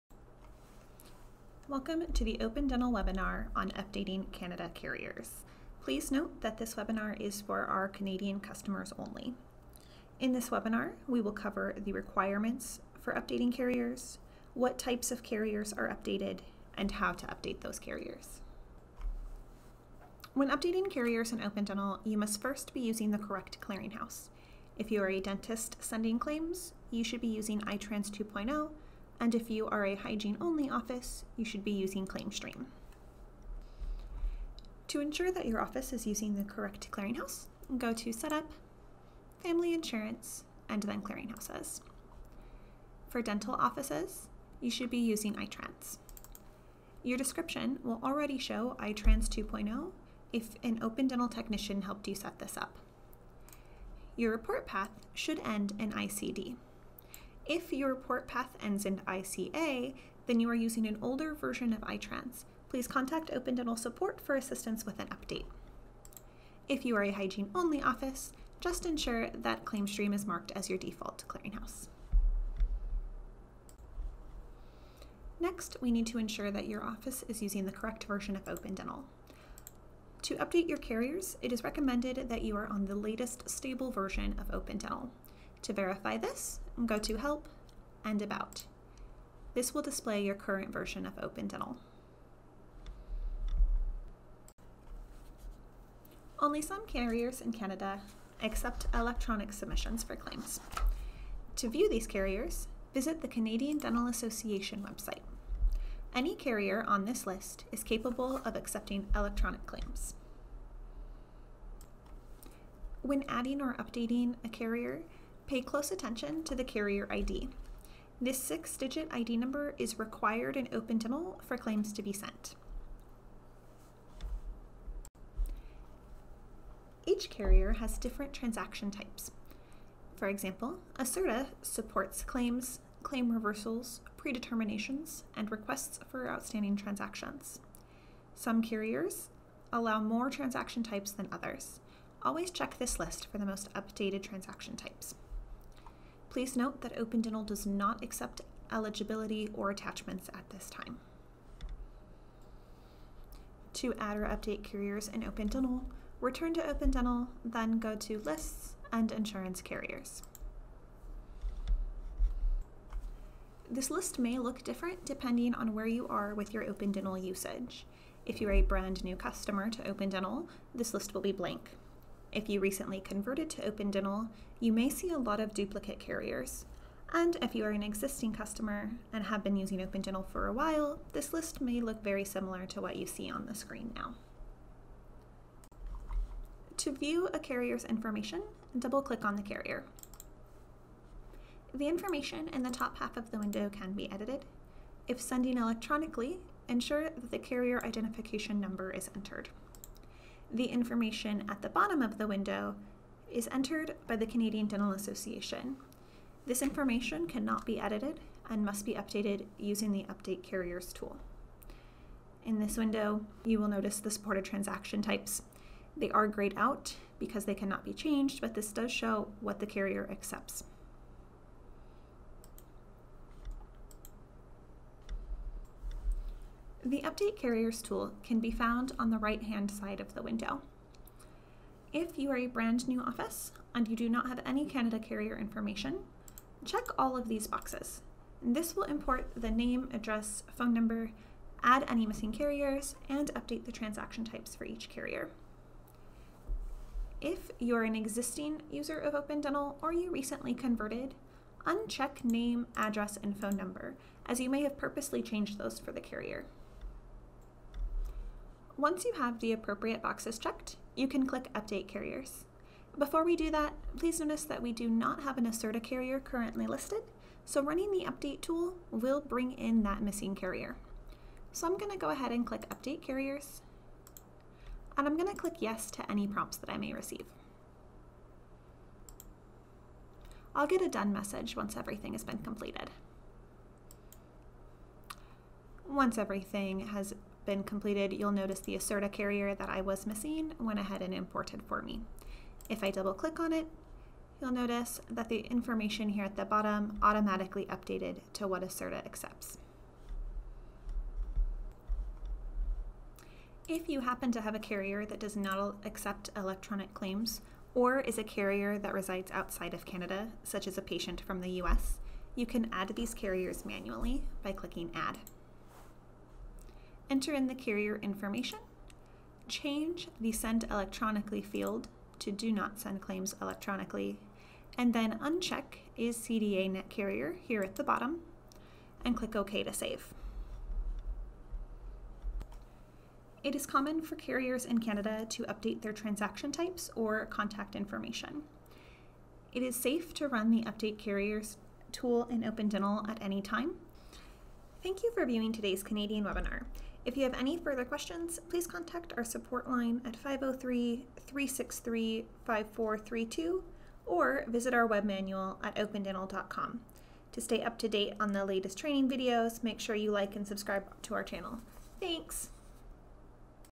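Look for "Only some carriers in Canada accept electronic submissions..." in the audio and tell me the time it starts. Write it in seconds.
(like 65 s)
96 s.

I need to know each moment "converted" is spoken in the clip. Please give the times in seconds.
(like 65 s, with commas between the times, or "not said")
173 s, 250 s.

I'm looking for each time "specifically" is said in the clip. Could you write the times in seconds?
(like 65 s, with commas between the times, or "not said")
not said.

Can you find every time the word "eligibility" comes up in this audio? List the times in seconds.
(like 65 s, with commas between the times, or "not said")
148 s.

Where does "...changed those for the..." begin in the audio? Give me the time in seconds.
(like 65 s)
255 s.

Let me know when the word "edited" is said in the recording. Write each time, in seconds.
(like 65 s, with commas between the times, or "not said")
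194 s, 207 s.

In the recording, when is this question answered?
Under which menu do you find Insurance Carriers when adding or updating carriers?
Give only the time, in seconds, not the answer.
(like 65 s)
158 s.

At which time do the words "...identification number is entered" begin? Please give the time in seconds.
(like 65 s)
197 s.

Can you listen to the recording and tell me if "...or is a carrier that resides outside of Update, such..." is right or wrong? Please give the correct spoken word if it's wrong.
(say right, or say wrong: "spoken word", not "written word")
wrong: "Canada", not "Update".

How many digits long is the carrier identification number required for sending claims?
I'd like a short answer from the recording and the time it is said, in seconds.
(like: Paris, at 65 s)
6, at 118 s.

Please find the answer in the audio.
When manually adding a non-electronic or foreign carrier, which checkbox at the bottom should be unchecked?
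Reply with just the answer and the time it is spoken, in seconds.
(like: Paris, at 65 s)
is CDA net carrier, at 325 s.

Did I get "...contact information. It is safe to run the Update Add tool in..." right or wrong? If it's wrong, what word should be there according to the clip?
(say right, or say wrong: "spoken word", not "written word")
wrong: "Carriers", not "Add".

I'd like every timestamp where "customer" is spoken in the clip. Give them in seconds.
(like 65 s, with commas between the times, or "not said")
8 s, 169 s, 178 s.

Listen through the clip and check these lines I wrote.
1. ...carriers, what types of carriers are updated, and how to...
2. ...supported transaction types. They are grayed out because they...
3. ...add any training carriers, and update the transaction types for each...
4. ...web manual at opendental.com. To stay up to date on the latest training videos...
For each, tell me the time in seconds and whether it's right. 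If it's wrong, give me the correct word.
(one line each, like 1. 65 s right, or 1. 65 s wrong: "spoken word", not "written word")
1. 13 s right
2. 214 s right
3. 241 s wrong: "missing", not "training"
4. 354 s right.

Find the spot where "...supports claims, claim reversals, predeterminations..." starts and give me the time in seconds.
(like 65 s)
131 s.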